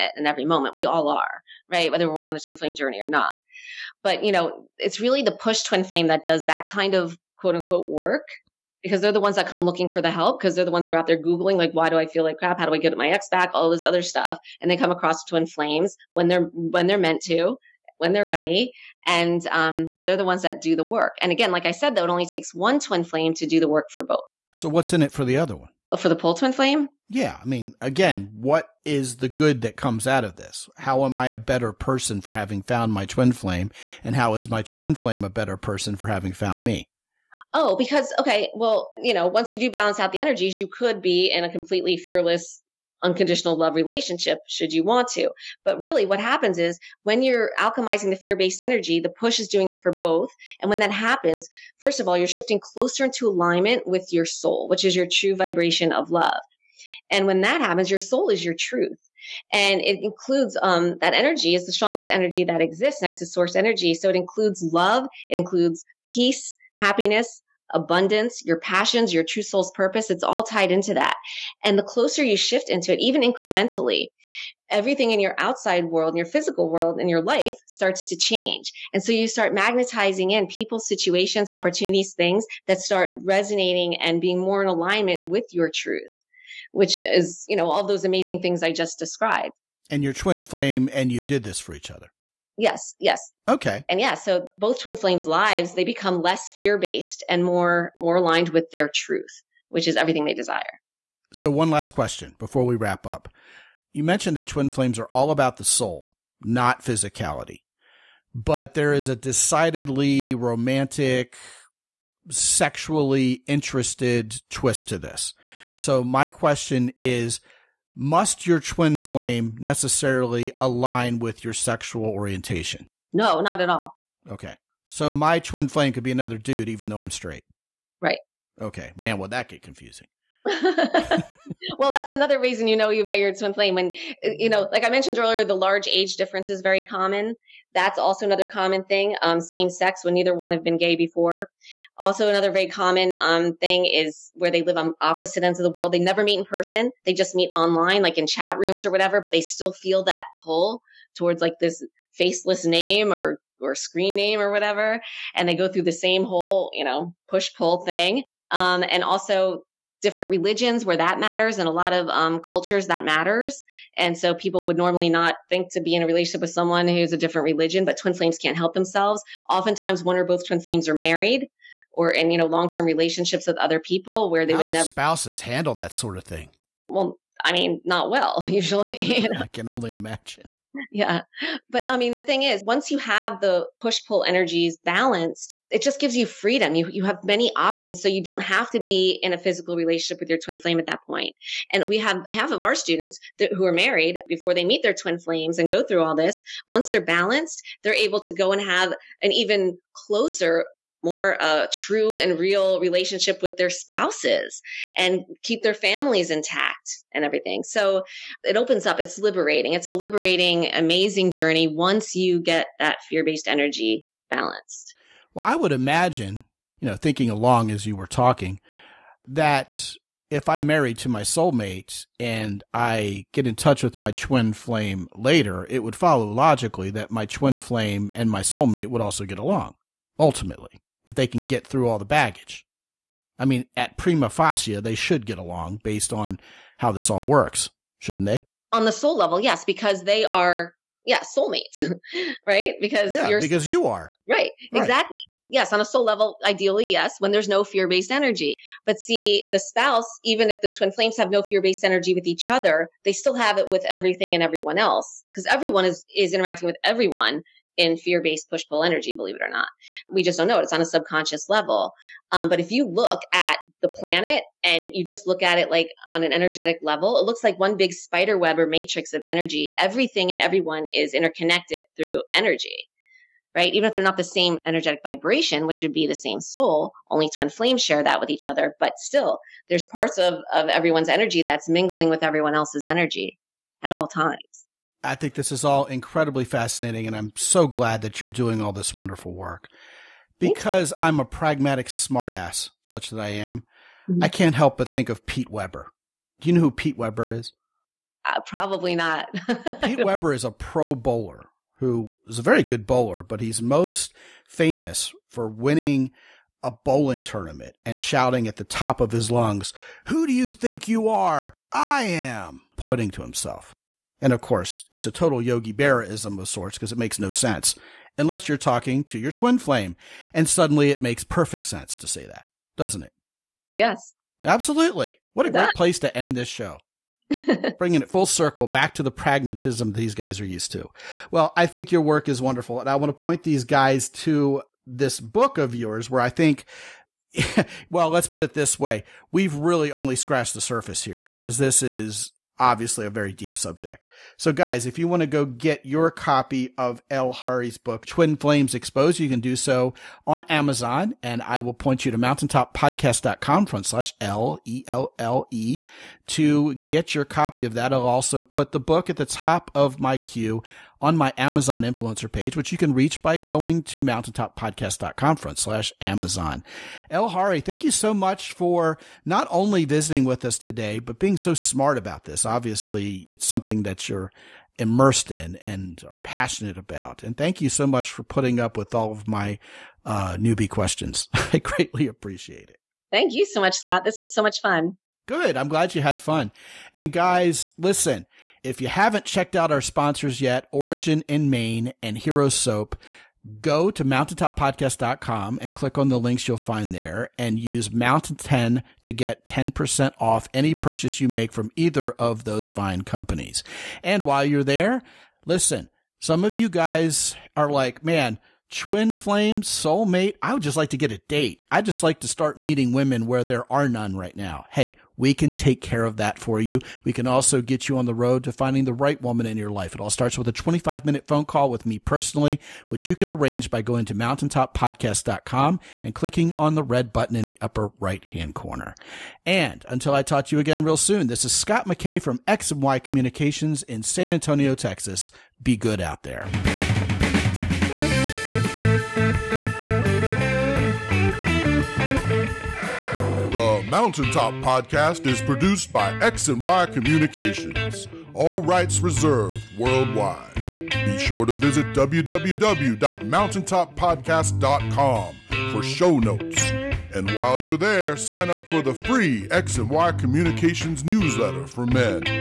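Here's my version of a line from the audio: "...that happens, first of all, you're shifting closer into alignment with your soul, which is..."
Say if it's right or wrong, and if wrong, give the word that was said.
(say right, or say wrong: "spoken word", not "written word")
right.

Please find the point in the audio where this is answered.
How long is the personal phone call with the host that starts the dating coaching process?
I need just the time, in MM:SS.
07:00.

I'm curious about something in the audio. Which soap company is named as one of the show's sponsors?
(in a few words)
Hero Soap.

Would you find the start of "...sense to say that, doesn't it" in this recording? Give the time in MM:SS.
05:21.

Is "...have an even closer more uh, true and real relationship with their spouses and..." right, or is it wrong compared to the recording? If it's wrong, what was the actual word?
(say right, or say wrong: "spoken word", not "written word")
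right.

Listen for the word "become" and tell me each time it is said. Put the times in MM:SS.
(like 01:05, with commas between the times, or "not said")
01:35.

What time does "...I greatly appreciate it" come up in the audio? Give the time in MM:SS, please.
06:21.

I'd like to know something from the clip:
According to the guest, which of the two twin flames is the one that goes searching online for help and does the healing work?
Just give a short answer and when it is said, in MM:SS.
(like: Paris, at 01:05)
The push twin flame, at 00:05.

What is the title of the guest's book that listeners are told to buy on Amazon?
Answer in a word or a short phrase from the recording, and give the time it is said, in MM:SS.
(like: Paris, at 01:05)
Twin Flames Exposed, at 05:48.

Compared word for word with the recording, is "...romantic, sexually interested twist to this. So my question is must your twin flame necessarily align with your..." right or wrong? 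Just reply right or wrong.
right.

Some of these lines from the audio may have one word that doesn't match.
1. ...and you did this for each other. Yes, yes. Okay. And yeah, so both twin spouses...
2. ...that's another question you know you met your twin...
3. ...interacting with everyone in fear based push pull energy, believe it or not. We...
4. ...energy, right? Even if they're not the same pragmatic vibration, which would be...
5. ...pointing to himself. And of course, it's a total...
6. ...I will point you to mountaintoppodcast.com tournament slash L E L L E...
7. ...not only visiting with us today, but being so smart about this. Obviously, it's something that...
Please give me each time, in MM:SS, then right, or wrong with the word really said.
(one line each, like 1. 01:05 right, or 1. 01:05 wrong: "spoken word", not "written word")
1. 01:30 wrong: "flames", not "spouses"
2. 02:11 wrong: "reason", not "question"
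3. 04:16 right
4. 04:32 wrong: "energetic", not "pragmatic"
5. 05:12 right
6. 05:51 wrong: "front", not "tournament"
7. 06:09 right.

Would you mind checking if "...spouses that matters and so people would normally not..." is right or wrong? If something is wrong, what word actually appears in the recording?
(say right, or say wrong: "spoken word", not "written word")
wrong: "cultures", not "spouses".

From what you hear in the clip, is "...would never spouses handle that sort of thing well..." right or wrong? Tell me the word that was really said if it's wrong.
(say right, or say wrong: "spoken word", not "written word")
right.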